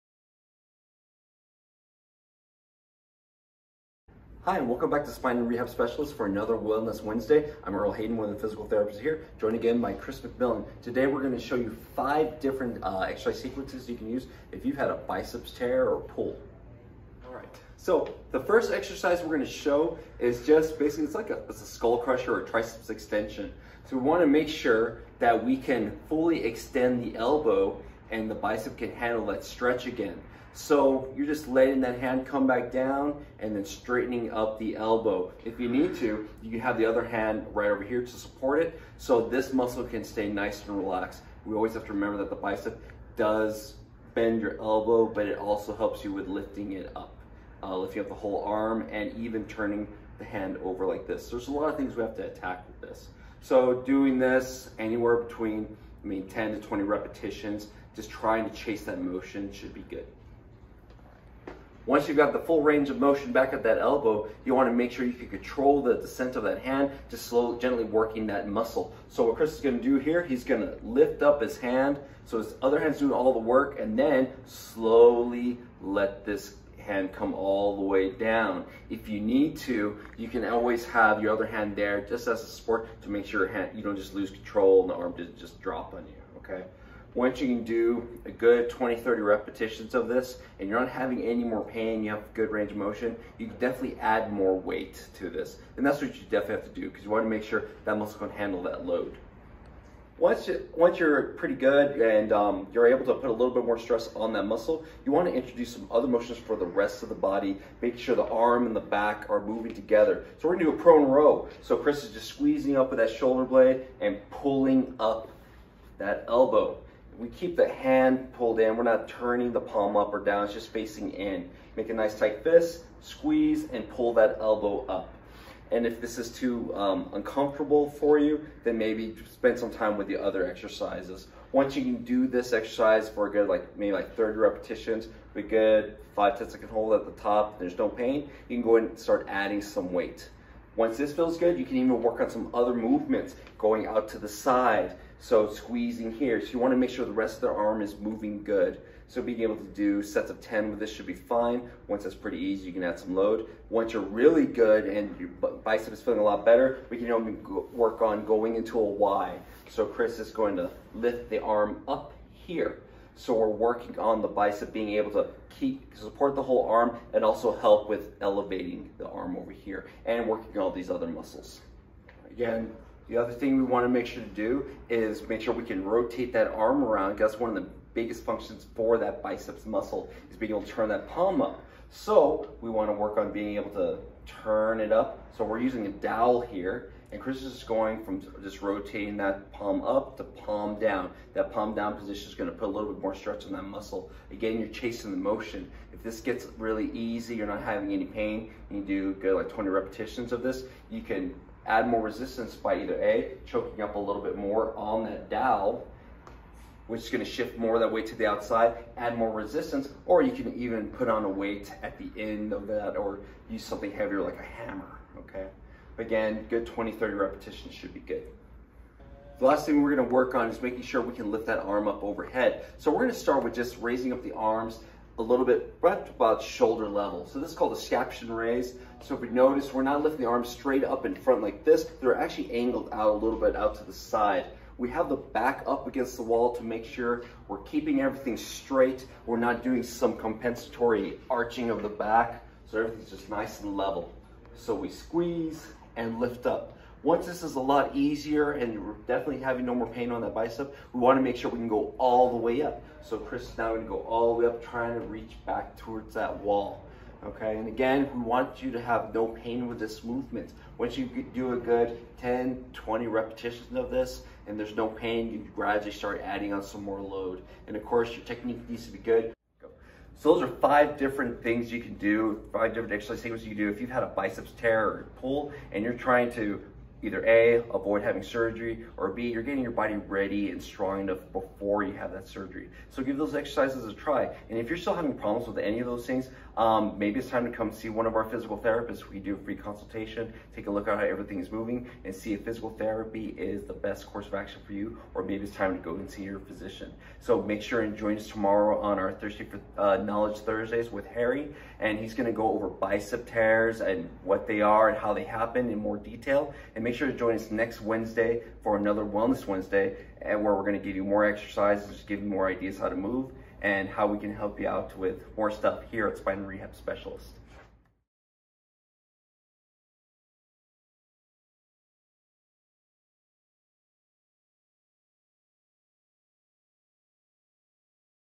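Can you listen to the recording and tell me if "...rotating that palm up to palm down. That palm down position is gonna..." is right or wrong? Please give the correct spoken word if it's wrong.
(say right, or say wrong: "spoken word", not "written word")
right.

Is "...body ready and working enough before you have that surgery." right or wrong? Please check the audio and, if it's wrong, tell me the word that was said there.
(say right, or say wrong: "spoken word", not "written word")
wrong: "strong", not "working".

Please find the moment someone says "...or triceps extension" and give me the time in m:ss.
0:22.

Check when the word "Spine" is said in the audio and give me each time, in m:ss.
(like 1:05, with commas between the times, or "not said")
0:05, 5:16.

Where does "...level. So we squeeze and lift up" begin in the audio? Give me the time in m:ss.
4:03.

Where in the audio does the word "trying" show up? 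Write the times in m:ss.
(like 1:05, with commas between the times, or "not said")
0:58, 4:14, 4:35.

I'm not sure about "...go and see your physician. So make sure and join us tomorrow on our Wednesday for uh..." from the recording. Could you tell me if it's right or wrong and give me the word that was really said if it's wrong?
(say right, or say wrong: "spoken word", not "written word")
wrong: "Thursday", not "Wednesday".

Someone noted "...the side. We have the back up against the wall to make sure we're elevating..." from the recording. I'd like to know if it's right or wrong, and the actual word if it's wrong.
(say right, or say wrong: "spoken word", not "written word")
wrong: "keeping", not "elevating".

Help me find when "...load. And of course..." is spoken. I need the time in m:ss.
4:27.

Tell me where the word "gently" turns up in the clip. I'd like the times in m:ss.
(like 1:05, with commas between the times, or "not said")
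1:07.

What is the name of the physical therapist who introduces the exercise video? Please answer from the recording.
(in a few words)
Earl Hayden.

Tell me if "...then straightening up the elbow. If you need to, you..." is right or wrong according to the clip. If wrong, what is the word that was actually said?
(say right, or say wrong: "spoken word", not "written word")
right.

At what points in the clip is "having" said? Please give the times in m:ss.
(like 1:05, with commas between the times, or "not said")
1:30, 3:17, 4:09, 4:38, 4:44.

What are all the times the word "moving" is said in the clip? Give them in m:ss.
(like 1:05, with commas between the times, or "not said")
1:49, 2:27, 4:51.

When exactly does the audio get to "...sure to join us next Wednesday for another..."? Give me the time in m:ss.
5:06.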